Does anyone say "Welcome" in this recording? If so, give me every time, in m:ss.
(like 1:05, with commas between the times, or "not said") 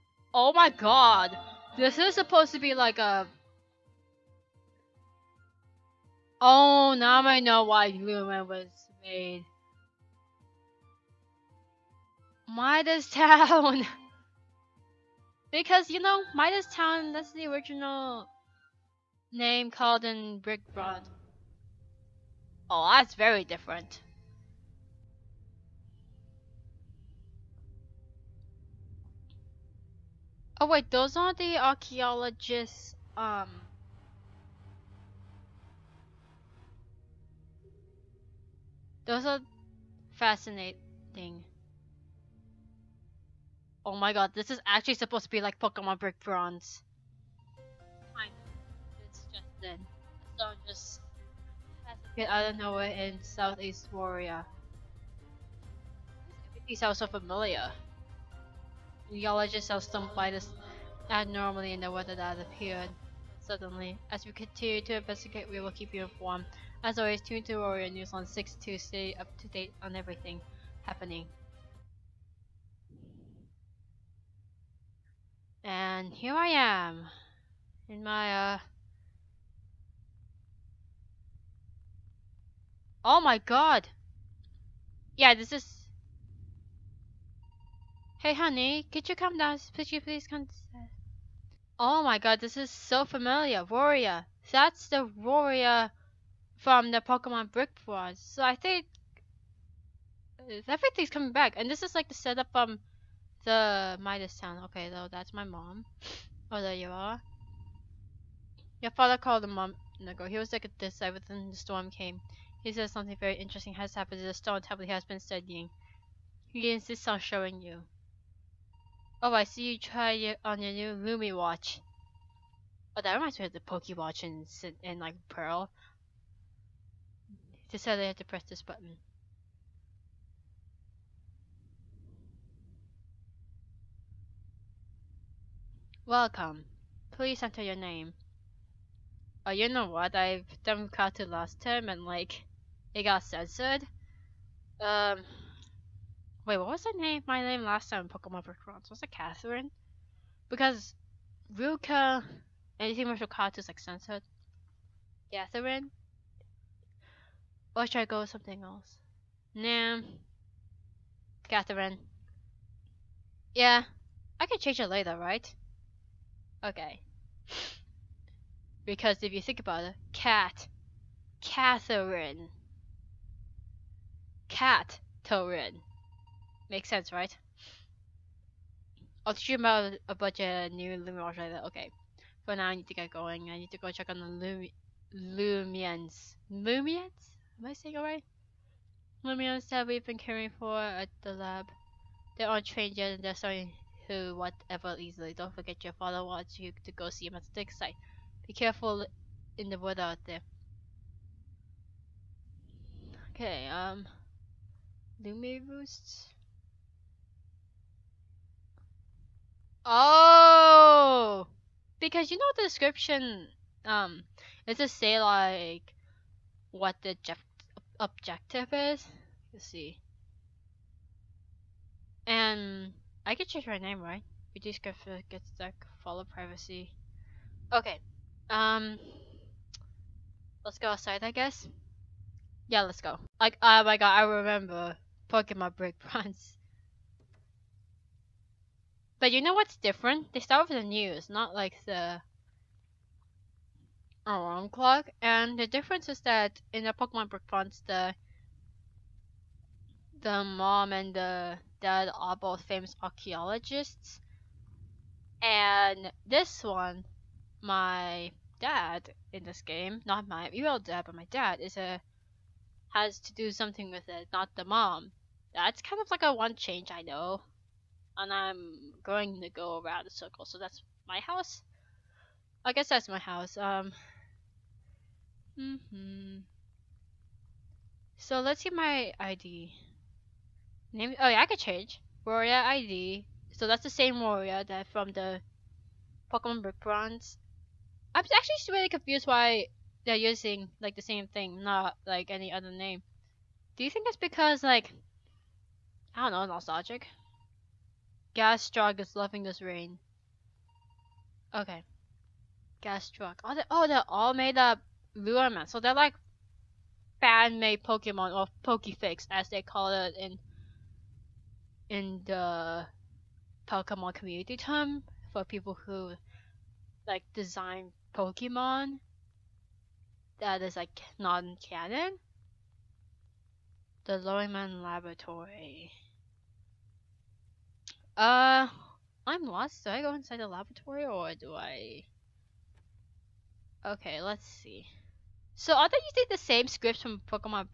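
2:16.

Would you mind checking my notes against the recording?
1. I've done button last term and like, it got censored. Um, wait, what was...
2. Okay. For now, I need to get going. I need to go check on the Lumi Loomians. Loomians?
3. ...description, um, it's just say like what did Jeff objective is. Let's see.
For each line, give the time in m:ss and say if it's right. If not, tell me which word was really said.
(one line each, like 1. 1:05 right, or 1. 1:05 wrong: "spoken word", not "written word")
1. 2:20 wrong: "cartoon", not "button"
2. 3:01 right
3. 3:32 right.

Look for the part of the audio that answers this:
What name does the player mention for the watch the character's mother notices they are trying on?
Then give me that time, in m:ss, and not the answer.
2:01.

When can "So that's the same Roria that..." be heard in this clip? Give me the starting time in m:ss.
4:43.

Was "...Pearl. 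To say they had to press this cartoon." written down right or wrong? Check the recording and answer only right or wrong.
wrong.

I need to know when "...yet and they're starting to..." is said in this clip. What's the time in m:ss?
3:12.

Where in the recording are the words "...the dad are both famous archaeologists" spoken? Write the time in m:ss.
4:11.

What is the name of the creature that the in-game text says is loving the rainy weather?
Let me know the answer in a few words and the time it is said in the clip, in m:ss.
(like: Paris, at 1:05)
Gastrock, at 4:58.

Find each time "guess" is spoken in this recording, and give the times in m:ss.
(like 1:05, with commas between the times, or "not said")
3:51, 4:32.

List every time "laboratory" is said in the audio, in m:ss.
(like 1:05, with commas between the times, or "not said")
5:24, 5:30.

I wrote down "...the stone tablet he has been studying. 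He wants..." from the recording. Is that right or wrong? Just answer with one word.
wrong.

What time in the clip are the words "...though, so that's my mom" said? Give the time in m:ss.
1:44.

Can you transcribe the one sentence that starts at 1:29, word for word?
Could you please come Oh my god, this is so familiar.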